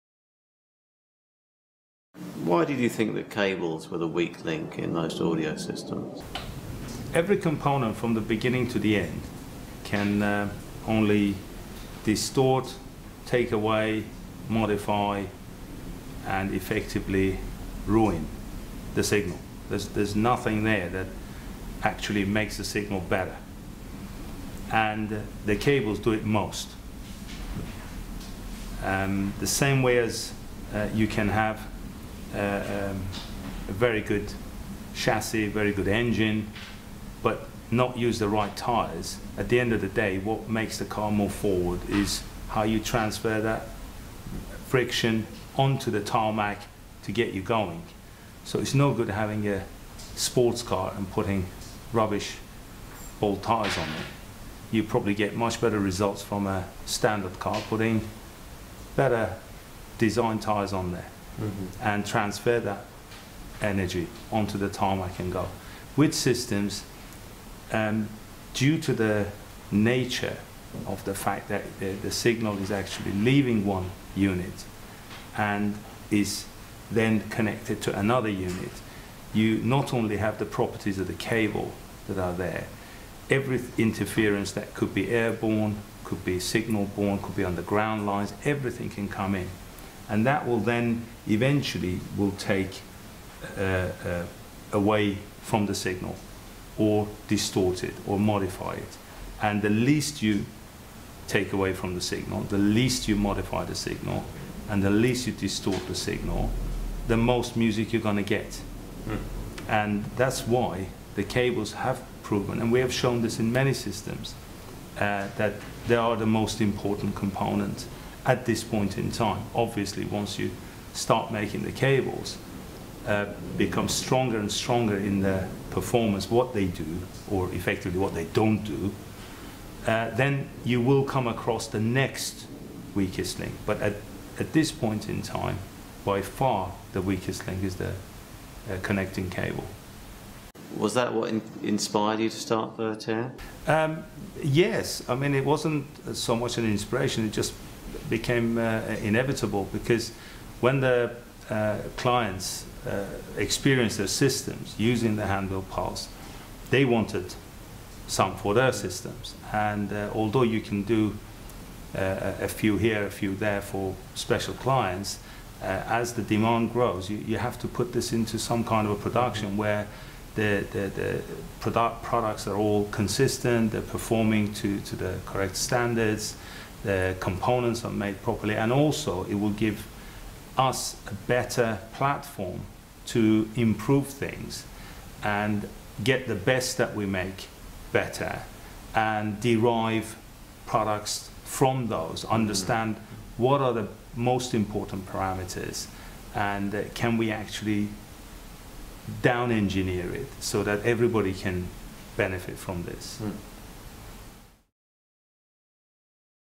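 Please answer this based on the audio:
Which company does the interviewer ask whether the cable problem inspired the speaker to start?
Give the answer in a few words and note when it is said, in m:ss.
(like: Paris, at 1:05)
Vertere, at 2:22.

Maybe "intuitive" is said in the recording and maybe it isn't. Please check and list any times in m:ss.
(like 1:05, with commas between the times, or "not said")
not said.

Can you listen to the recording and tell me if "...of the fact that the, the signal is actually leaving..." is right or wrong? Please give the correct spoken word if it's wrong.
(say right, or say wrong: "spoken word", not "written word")
right.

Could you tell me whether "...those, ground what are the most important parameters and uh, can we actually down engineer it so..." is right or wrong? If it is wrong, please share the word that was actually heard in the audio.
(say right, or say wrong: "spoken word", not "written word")
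wrong: "understand", not "ground".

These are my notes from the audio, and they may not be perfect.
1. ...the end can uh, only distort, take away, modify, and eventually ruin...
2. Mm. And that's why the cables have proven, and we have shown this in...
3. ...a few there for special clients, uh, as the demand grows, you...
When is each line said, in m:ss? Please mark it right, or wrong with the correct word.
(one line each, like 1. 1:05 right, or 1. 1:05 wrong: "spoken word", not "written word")
1. 0:08 wrong: "effectively", not "eventually"
2. 1:49 right
3. 2:43 right.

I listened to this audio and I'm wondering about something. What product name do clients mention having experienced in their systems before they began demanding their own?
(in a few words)
Handle pulse.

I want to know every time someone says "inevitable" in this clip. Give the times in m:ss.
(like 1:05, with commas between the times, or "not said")
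2:29.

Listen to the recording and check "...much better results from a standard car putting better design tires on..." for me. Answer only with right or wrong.
right.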